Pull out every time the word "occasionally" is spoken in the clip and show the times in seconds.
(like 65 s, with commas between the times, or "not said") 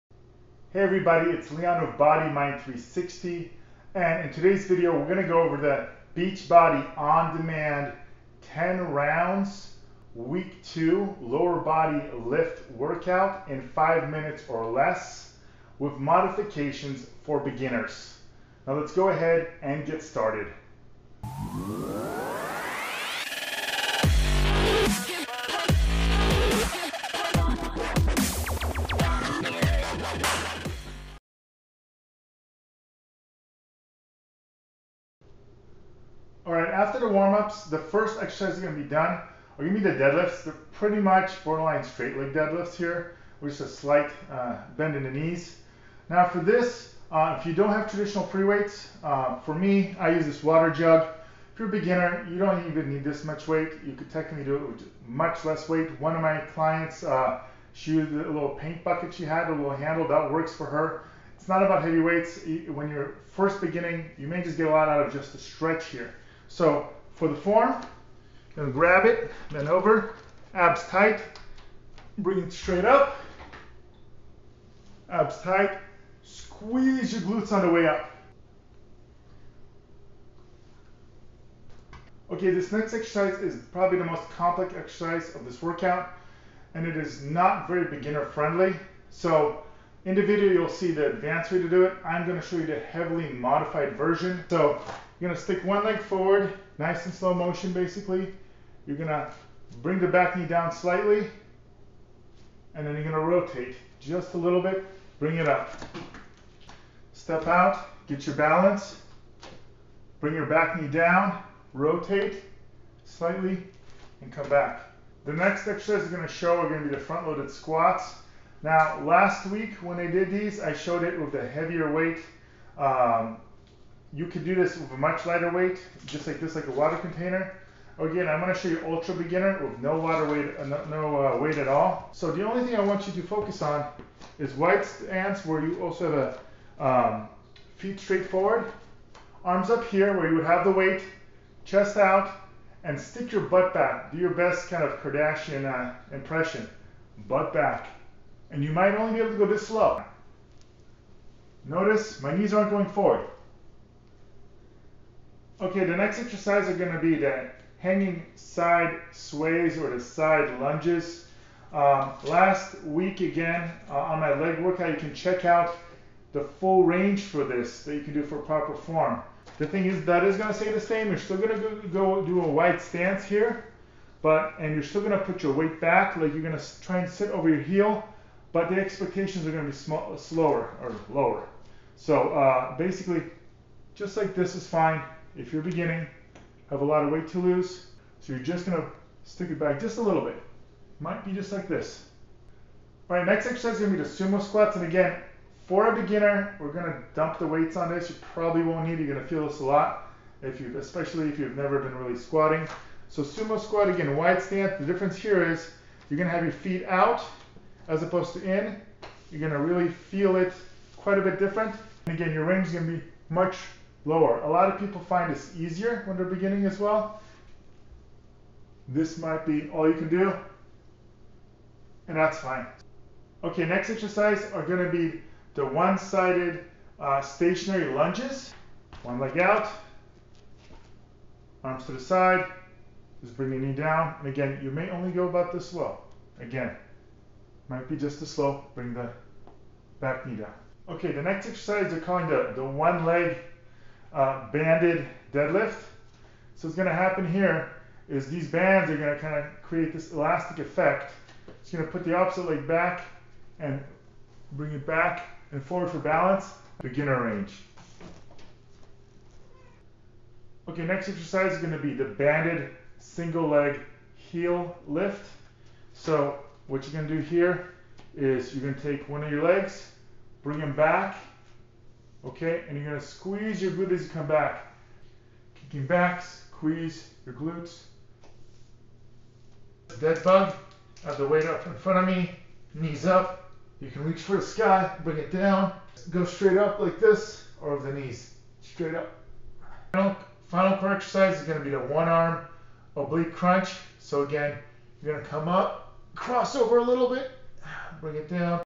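not said.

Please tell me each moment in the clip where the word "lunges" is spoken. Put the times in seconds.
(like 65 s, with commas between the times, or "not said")
160 s, 227 s.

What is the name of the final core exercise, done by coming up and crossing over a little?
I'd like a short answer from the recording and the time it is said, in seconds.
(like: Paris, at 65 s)
one arm oblique crunch, at 291 s.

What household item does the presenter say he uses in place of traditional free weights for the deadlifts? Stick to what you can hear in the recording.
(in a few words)
water jug.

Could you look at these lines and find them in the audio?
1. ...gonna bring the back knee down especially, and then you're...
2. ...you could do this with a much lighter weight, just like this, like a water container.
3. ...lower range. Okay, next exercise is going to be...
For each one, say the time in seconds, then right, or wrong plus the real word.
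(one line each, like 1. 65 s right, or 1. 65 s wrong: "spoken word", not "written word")
1. 98 s wrong: "slightly", not "especially"
2. 124 s right
3. 256 s wrong: "beginner", not "lower".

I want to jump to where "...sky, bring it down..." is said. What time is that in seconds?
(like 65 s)
284 s.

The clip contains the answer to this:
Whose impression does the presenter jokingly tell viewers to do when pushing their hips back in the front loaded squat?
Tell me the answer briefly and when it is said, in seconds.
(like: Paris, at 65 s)
Kardashian, at 144 s.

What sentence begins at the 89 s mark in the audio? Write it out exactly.
So in the video, you'll see the advanced way to do it.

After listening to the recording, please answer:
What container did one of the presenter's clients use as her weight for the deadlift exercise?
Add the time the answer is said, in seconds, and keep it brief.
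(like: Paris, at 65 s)
paint bucket, at 58 s.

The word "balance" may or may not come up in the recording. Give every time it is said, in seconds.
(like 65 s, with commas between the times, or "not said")
108 s, 255 s.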